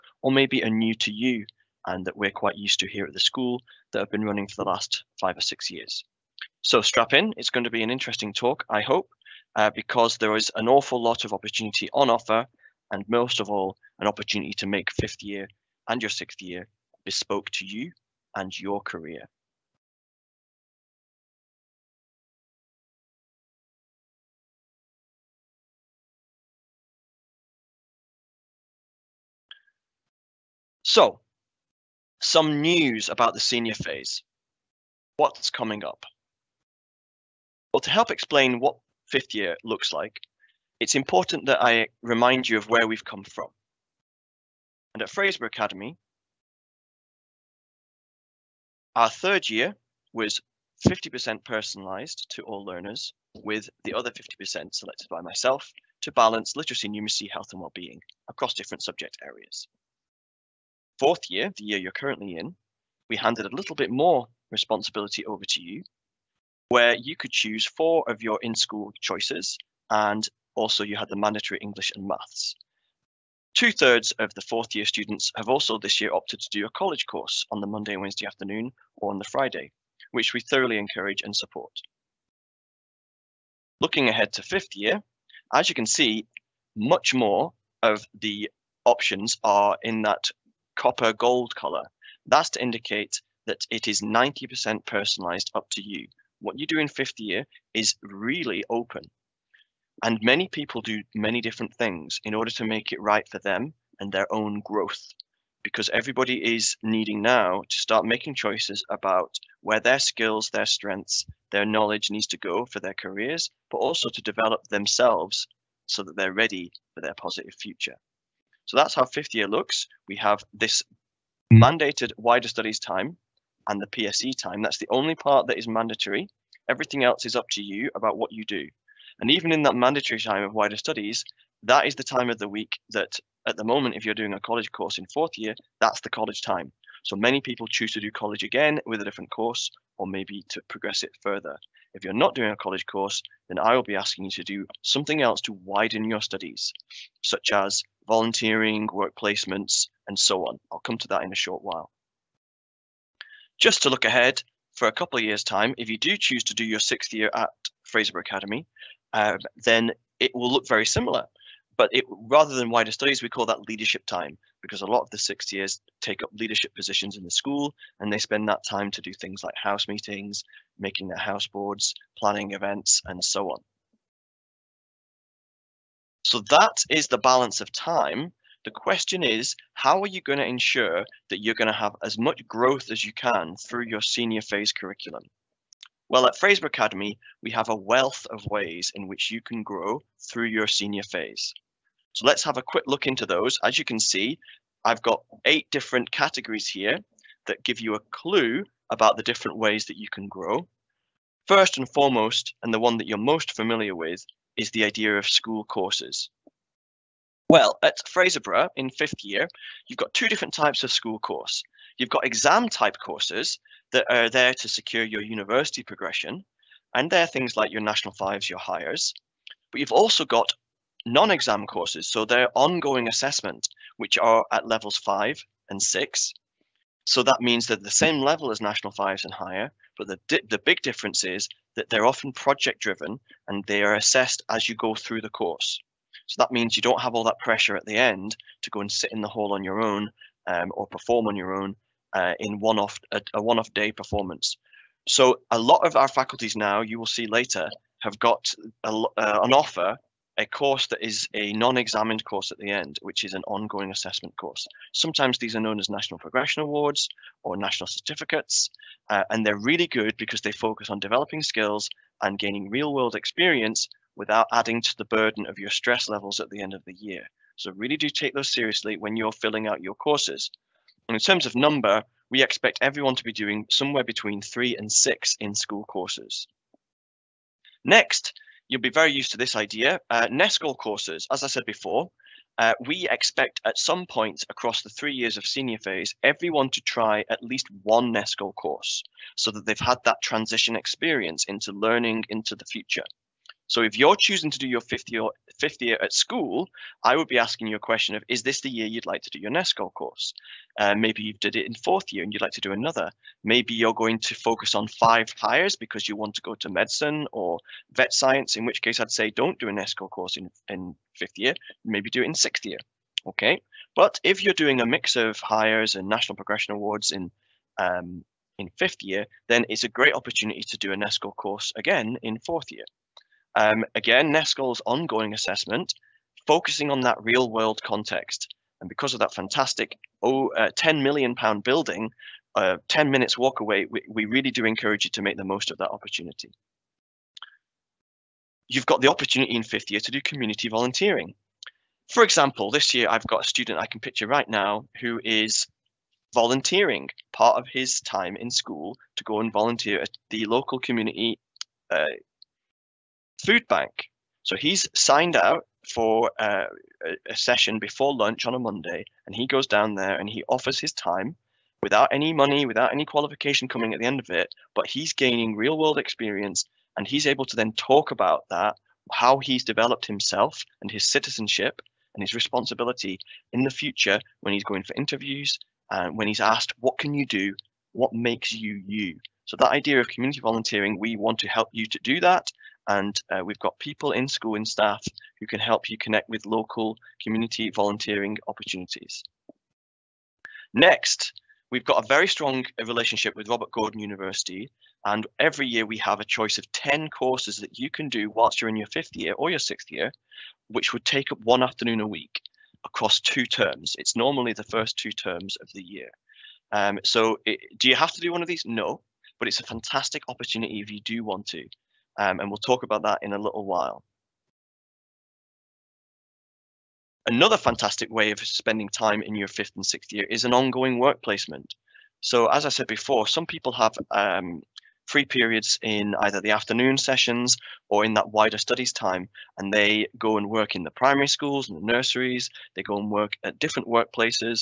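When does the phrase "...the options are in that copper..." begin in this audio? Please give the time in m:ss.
1:28.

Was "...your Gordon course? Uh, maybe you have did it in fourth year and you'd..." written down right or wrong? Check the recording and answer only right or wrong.
wrong.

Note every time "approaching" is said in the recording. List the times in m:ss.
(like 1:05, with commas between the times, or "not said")
not said.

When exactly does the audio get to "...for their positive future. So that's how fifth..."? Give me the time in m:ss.
1:56.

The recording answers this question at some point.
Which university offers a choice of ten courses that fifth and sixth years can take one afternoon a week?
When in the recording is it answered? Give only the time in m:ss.
6:33.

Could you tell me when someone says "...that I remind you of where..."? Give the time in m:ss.
0:41.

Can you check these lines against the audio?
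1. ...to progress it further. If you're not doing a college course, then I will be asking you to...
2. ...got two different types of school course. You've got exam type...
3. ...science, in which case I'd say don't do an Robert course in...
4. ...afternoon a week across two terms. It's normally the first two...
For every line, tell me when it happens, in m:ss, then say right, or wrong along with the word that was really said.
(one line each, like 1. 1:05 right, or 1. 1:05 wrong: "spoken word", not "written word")
1. 2:20 right
2. 3:29 right
3. 5:08 wrong: "NESCOL", not "Robert"
4. 6:41 right.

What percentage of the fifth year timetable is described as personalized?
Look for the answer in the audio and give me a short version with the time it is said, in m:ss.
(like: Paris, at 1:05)
90%, at 1:34.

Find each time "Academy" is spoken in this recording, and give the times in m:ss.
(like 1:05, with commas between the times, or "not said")
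0:45, 2:38, 3:06.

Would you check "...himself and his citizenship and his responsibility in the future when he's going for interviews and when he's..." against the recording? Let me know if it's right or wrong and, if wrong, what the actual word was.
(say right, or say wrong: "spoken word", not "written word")
right.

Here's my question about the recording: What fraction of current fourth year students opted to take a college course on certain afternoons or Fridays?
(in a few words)
Two thirds.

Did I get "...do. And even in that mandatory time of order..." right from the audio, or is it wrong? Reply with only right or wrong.
wrong.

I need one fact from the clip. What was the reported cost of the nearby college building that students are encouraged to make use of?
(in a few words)
10 million pounds.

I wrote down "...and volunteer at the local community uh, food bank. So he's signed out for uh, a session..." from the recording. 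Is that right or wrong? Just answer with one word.
right.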